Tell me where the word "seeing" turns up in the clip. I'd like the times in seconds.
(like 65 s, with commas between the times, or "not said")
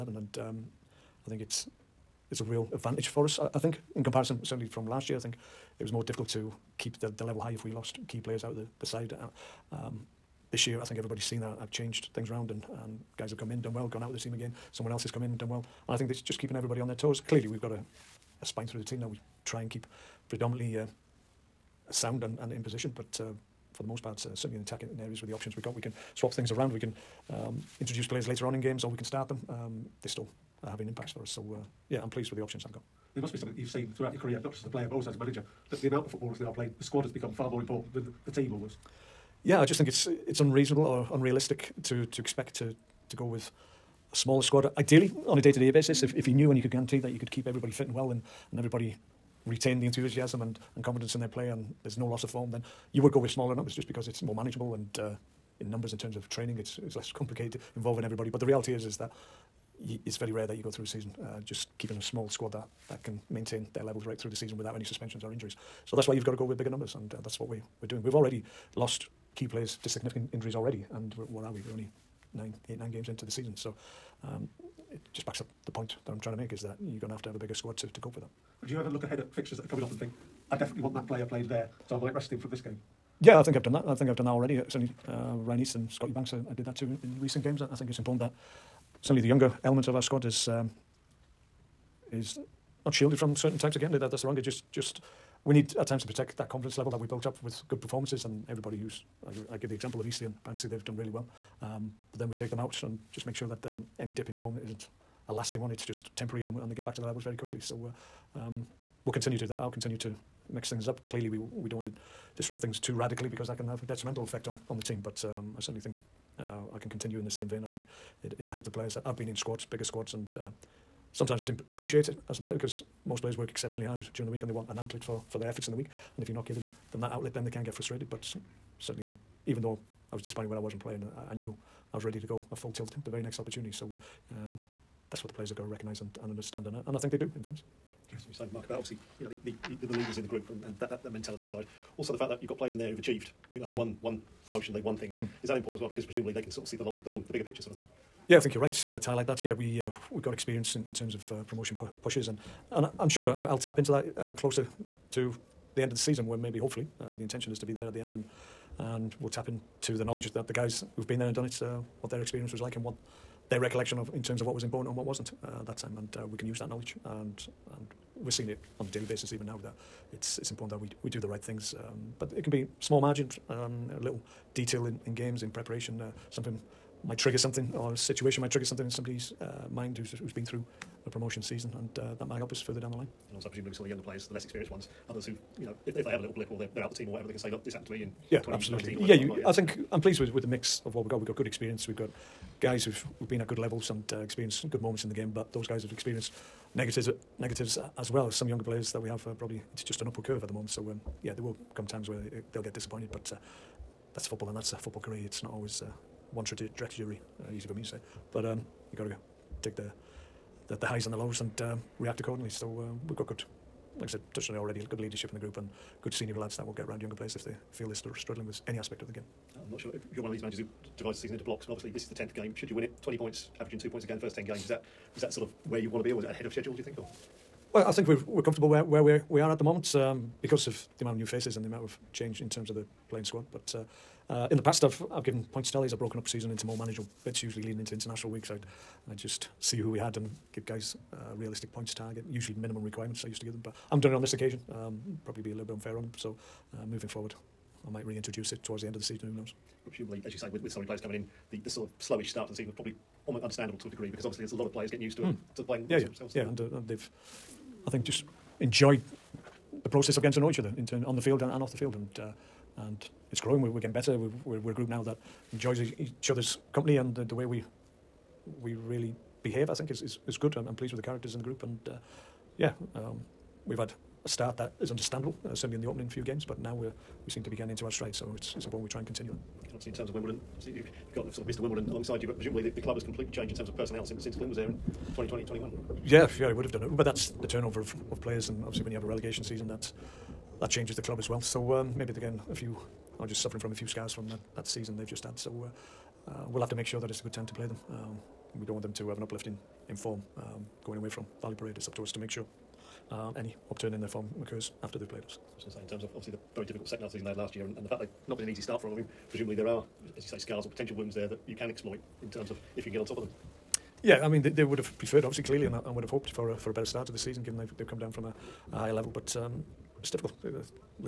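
168 s.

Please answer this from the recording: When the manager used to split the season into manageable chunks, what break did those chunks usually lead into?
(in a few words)
International week.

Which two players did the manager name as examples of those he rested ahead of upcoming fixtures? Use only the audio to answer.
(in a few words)
Ryan East and Scotty Banks.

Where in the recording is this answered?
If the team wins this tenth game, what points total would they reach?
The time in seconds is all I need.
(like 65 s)
223 s.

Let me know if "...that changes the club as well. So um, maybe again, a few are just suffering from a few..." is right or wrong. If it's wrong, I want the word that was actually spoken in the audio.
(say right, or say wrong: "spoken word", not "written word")
right.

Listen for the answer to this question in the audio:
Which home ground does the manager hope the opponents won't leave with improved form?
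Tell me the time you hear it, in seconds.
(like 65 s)
301 s.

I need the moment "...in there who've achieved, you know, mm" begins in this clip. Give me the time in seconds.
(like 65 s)
142 s.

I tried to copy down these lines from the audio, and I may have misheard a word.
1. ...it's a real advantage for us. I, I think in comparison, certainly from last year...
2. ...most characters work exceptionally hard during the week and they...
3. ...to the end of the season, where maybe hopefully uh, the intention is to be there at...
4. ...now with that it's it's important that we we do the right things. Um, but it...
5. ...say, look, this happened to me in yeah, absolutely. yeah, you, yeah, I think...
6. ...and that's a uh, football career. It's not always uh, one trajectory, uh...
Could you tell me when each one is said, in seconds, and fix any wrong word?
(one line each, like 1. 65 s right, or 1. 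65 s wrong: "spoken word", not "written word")
1. 2 s right
2. 123 s wrong: "players", not "characters"
3. 155 s right
4. 169 s right
5. 187 s right
6. 204 s right.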